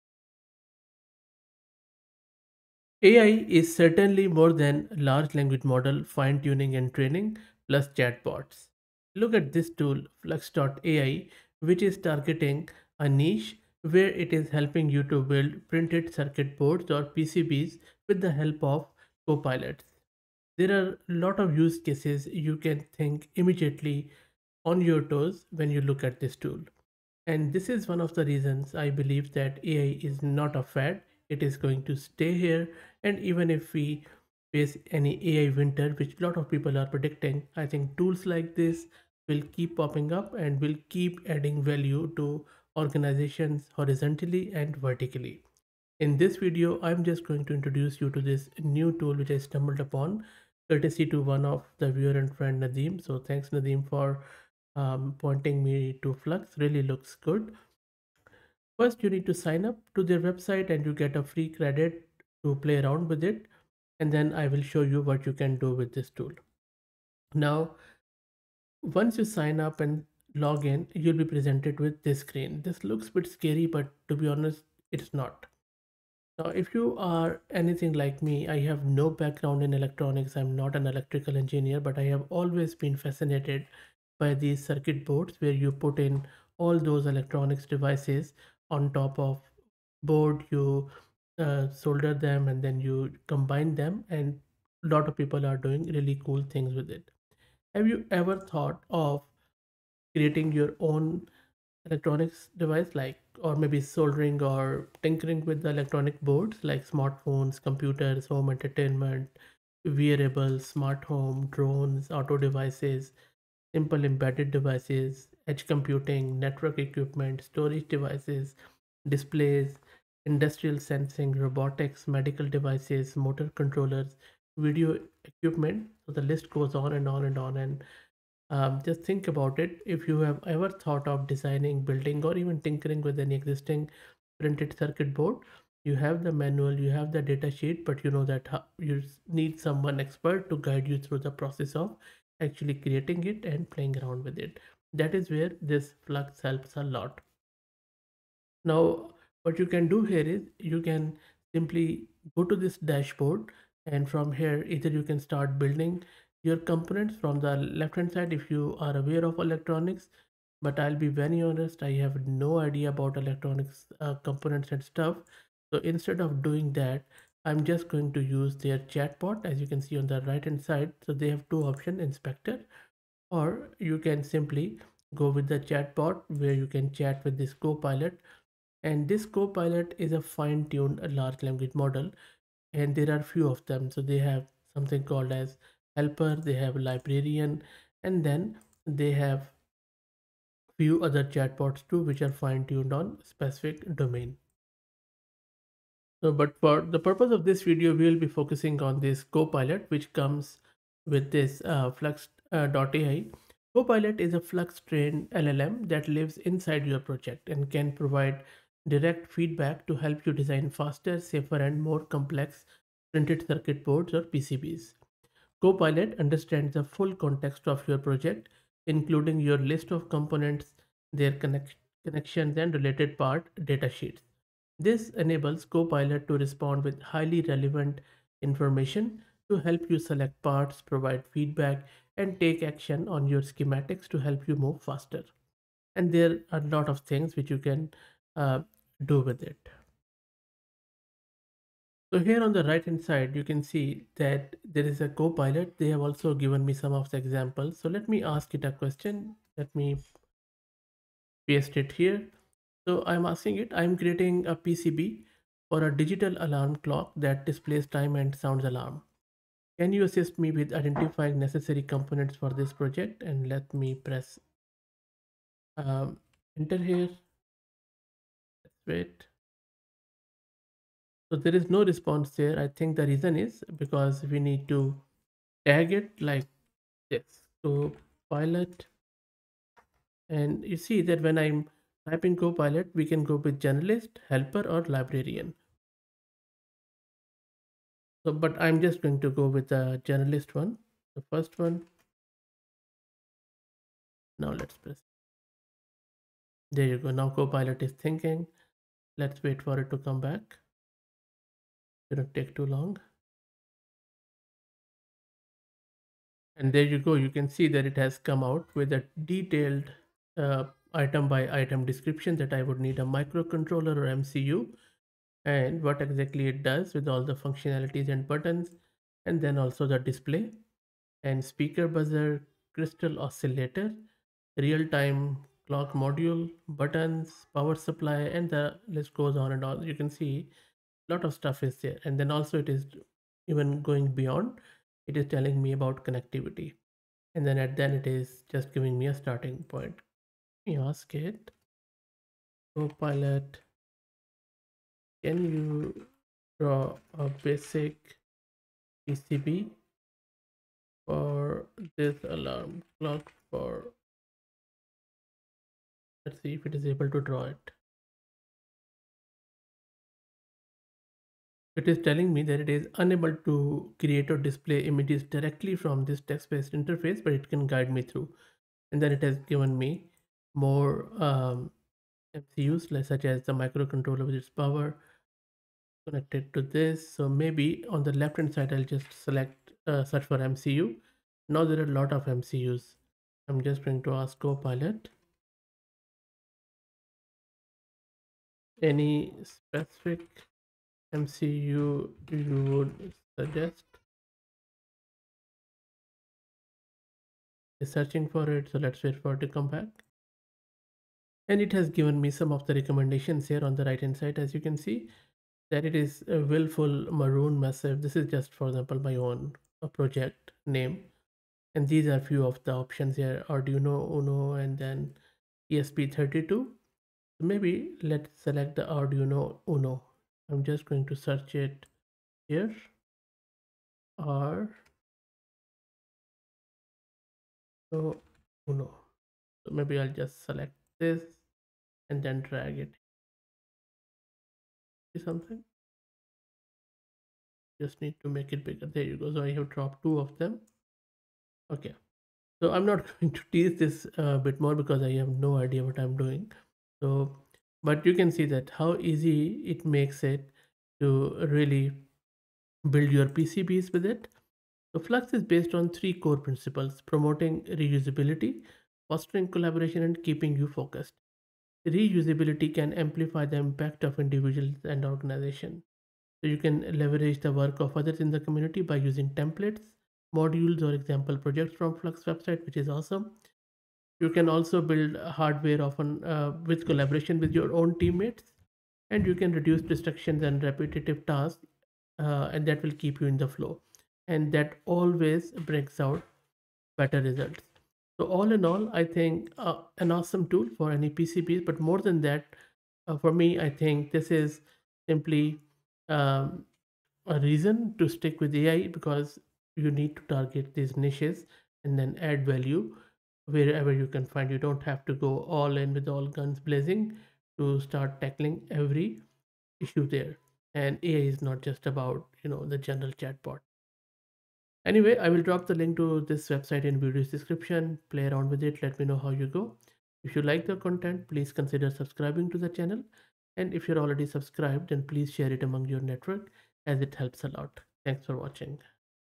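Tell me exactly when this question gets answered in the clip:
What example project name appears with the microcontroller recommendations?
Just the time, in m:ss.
6:46.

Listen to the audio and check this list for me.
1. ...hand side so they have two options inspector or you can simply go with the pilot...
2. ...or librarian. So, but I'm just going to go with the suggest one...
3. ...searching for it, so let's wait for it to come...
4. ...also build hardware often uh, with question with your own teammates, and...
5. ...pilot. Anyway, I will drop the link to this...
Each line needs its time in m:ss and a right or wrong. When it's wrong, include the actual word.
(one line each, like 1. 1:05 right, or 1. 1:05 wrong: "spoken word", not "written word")
1. 2:50 wrong: "chatbot", not "pilot"
2. 4:44 wrong: "generalist", not "suggest"
3. 6:37 right
4. 7:54 wrong: "collaboration", not "question"
5. 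8:33 wrong: "chatbot", not "pilot".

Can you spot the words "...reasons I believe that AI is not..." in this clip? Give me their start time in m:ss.
0:28.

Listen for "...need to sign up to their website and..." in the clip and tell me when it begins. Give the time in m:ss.
0:59.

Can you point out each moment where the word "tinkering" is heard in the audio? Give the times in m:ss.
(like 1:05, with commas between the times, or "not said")
1:45, 2:12.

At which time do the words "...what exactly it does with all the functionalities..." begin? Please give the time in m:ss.
5:15.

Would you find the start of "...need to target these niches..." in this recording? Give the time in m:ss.
8:19.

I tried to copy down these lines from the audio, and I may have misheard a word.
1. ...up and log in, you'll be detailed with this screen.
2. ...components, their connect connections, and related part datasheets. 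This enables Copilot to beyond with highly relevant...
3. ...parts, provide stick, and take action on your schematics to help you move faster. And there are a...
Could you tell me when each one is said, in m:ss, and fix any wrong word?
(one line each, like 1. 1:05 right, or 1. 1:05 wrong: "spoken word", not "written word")
1. 1:09 wrong: "presented", not "detailed"
2. 3:40 wrong: "respond", not "beyond"
3. 3:50 wrong: "feedback", not "stick".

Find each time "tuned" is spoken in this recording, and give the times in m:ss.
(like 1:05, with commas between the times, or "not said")
3:00, 3:12.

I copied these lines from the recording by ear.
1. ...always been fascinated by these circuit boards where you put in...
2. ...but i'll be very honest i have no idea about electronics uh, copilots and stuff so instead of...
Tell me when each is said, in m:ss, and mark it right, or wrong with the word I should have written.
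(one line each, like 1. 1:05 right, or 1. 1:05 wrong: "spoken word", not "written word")
1. 1:22 right
2. 2:40 wrong: "components", not "copilots".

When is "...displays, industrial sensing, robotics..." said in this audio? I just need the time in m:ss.
1:59.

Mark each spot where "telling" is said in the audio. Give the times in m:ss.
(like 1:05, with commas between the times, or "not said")
5:35, 6:02.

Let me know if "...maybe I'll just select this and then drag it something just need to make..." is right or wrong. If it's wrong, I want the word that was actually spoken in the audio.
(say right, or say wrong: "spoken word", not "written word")
right.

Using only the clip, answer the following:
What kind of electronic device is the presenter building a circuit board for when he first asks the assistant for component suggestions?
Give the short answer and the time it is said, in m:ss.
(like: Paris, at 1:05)
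Digital alarm clock, at 4:16.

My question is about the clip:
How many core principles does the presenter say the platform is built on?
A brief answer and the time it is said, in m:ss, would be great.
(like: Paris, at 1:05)
3, at 7:35.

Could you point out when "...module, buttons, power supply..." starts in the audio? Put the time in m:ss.
5:25.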